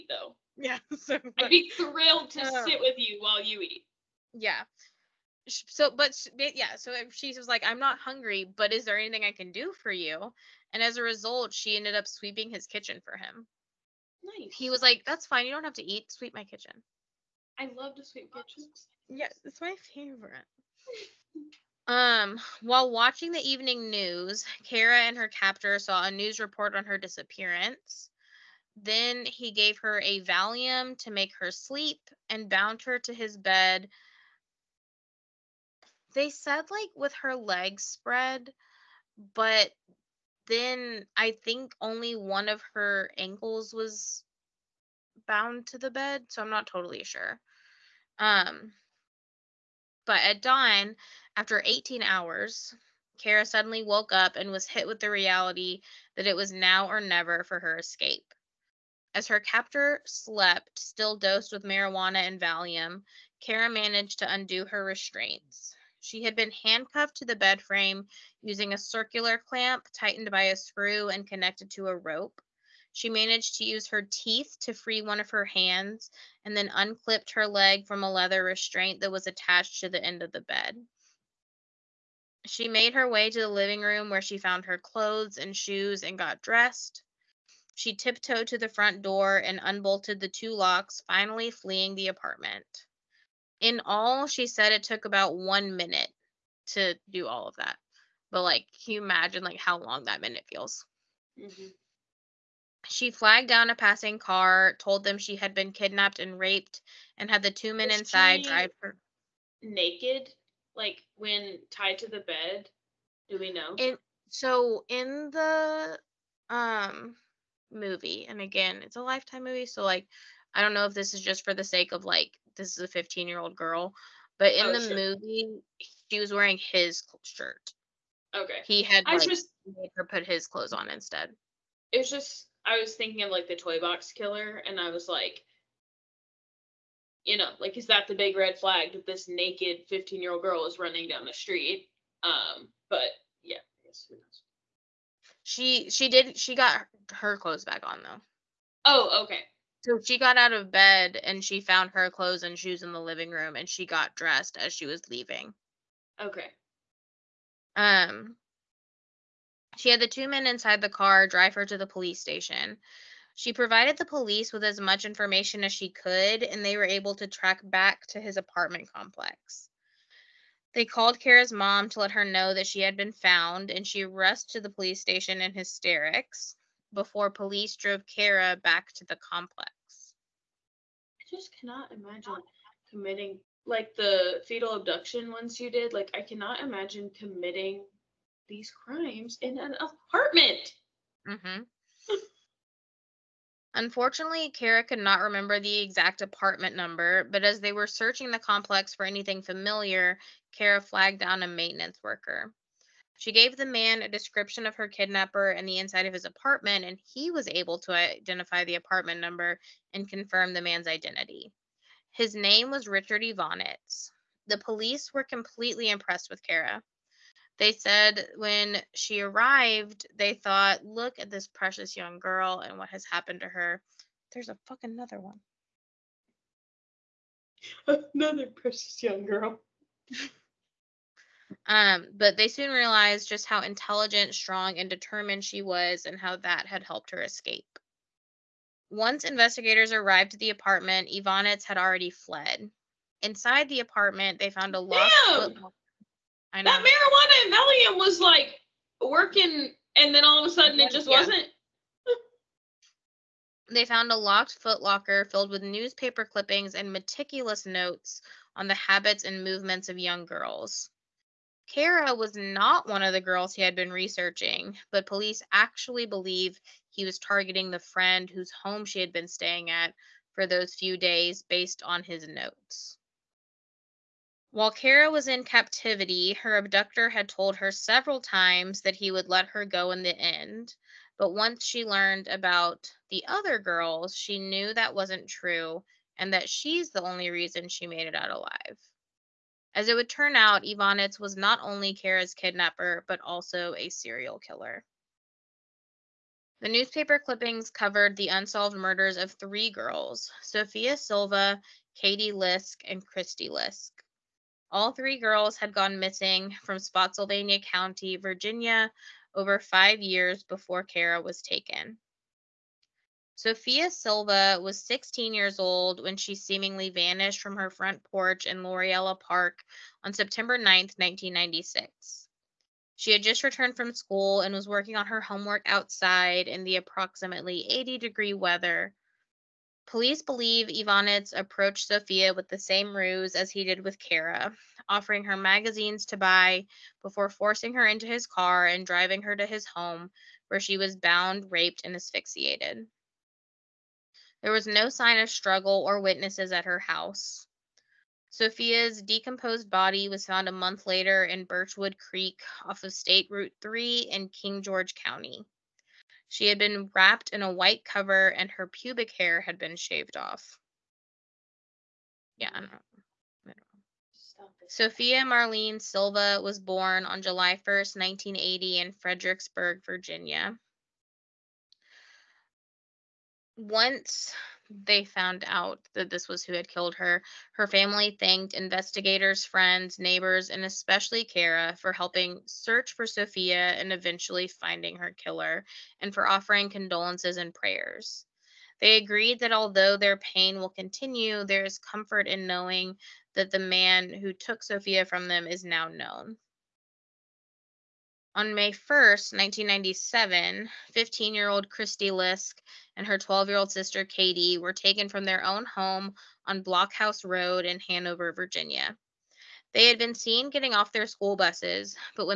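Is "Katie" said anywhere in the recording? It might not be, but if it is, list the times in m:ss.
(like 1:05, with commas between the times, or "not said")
5:01, 6:44.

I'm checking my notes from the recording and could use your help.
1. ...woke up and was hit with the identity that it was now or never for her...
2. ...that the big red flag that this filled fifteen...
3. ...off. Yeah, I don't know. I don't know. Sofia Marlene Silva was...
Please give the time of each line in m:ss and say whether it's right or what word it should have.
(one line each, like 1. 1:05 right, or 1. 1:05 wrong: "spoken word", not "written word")
1. 0:53 wrong: "reality", not "identity"
2. 2:17 wrong: "naked", not "filled"
3. 6:00 right.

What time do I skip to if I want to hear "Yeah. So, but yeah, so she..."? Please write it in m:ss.
0:04.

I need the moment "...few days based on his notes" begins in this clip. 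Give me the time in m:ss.
4:30.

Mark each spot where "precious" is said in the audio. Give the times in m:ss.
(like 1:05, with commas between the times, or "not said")
3:41, 3:48.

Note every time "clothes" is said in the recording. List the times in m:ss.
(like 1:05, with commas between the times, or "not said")
1:24, 2:10, 2:27, 2:32.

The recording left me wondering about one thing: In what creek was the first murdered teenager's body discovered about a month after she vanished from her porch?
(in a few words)
Birchwood Creek.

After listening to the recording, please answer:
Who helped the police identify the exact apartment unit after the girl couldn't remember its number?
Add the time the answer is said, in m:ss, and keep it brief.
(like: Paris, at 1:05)
A maintenance worker, at 3:21.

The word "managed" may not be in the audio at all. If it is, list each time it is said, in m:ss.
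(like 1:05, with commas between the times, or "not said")
1:03, 1:13.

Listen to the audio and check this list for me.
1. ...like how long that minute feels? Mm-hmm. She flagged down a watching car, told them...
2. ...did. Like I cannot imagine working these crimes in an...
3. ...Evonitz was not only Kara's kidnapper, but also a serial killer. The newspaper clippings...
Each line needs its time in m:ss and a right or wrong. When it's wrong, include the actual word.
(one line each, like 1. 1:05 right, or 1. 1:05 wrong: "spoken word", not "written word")
1. 1:39 wrong: "passing", not "watching"
2. 3:05 wrong: "committing", not "working"
3. 4:50 right.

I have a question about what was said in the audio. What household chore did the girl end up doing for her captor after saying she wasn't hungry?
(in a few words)
Sweeping his kitchen.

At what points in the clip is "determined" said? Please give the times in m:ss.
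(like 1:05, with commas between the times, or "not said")
3:54.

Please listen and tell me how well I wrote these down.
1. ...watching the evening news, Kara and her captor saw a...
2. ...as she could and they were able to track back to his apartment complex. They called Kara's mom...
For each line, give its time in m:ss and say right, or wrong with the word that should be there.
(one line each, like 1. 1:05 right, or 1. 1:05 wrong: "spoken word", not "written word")
1. 0:22 right
2. 2:45 right.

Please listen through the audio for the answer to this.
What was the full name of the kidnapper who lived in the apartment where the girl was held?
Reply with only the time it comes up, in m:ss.
3:32.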